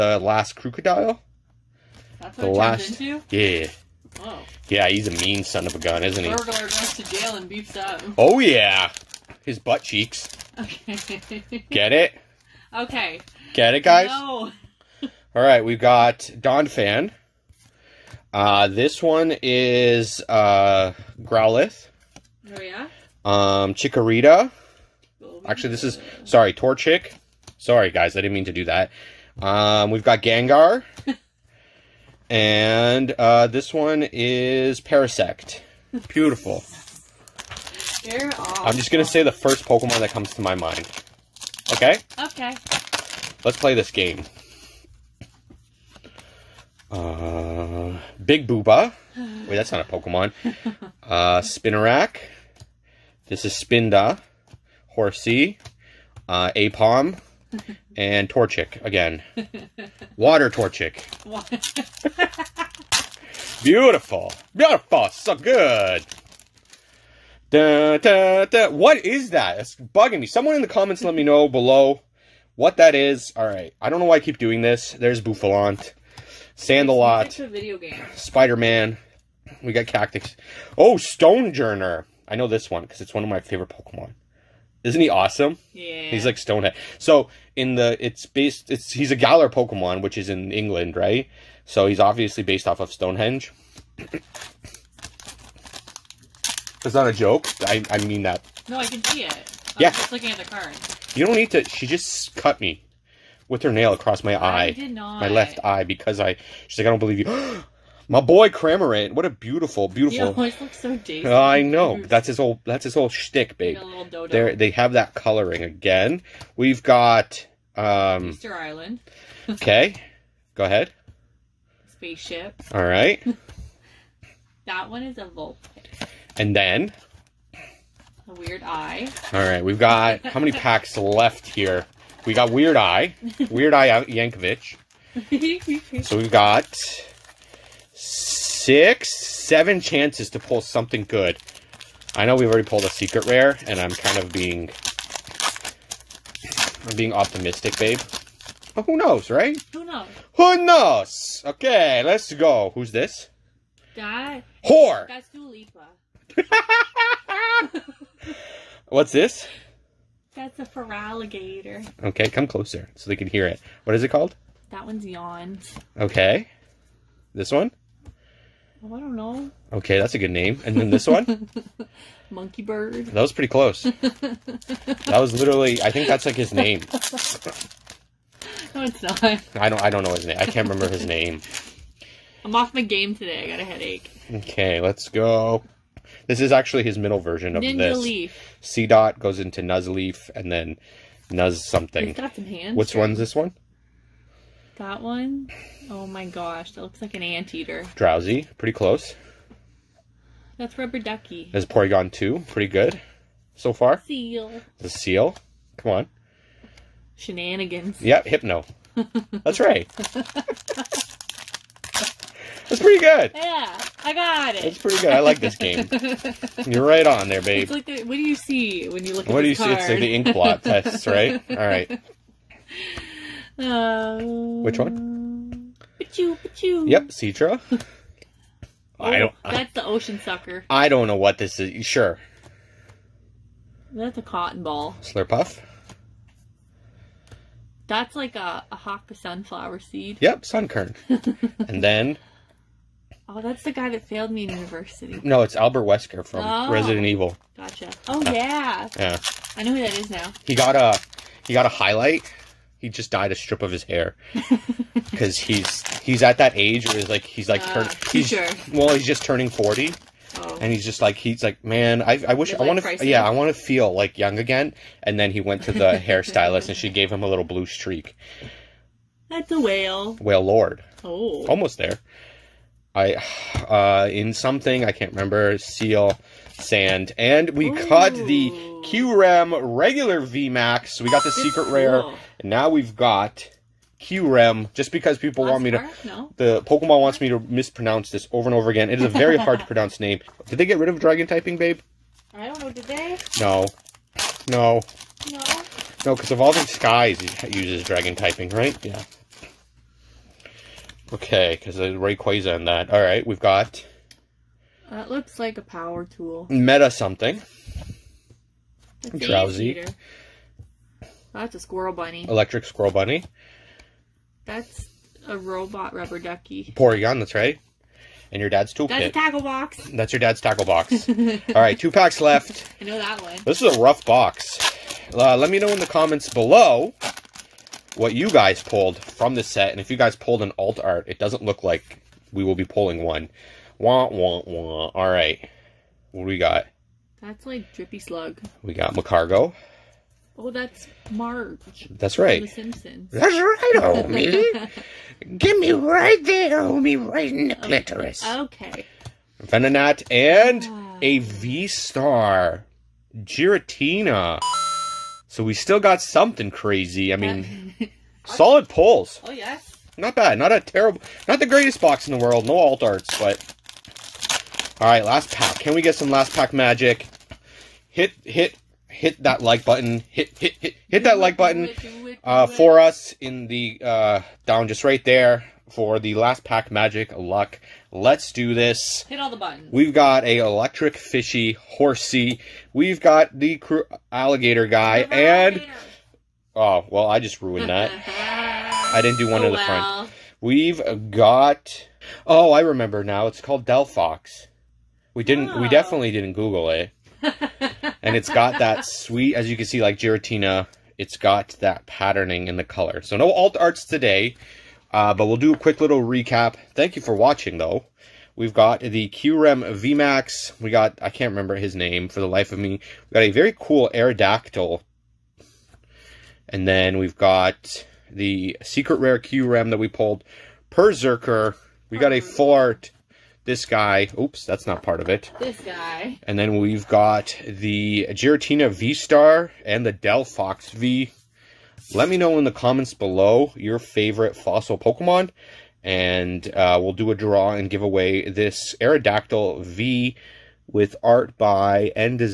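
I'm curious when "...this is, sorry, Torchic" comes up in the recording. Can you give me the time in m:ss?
0:25.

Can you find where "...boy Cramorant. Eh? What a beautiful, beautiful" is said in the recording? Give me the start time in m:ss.
1:48.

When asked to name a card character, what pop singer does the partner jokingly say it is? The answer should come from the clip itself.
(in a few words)
Dua Lipa.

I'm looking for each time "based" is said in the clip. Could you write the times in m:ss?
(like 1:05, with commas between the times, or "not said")
1:28, 1:32.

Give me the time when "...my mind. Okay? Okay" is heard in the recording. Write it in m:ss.
0:40.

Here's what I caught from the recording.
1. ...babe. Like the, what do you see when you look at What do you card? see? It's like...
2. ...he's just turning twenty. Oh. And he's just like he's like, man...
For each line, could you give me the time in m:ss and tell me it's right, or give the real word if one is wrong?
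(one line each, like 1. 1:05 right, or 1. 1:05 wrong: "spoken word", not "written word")
1. 3:37 right
2. 4:18 wrong: "forty", not "twenty".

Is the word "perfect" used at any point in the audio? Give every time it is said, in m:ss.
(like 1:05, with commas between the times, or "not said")
not said.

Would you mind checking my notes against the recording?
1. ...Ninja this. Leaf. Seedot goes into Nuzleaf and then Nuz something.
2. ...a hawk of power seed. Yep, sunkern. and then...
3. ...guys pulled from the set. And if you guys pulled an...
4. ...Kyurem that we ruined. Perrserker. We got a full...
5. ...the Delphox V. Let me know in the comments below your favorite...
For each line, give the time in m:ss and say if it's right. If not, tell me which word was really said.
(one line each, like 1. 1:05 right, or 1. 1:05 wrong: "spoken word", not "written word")
1. 3:07 right
2. 3:58 wrong: "sunflower", not "power"
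3. 5:28 right
4. 6:59 wrong: "pulled", not "ruined"
5. 7:09 right.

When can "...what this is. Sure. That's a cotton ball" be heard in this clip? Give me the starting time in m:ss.
3:51.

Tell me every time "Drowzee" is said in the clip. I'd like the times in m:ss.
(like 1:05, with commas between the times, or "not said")
3:17, 5:09.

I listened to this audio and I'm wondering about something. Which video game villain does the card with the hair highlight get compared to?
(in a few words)
Albert Wesker.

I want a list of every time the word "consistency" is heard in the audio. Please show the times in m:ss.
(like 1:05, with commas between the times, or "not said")
not said.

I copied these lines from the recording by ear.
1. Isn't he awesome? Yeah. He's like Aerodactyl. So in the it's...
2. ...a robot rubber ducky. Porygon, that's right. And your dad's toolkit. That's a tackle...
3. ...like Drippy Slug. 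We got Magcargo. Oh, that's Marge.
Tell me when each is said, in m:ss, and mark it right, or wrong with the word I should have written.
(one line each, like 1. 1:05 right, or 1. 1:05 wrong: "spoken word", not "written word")
1. 1:24 wrong: "Stonehead", not "Aerodactyl"
2. 5:15 right
3. 5:37 right.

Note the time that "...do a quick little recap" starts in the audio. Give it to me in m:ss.
6:45.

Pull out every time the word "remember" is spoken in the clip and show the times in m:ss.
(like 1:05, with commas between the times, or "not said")
3:00, 4:35, 6:32, 6:51.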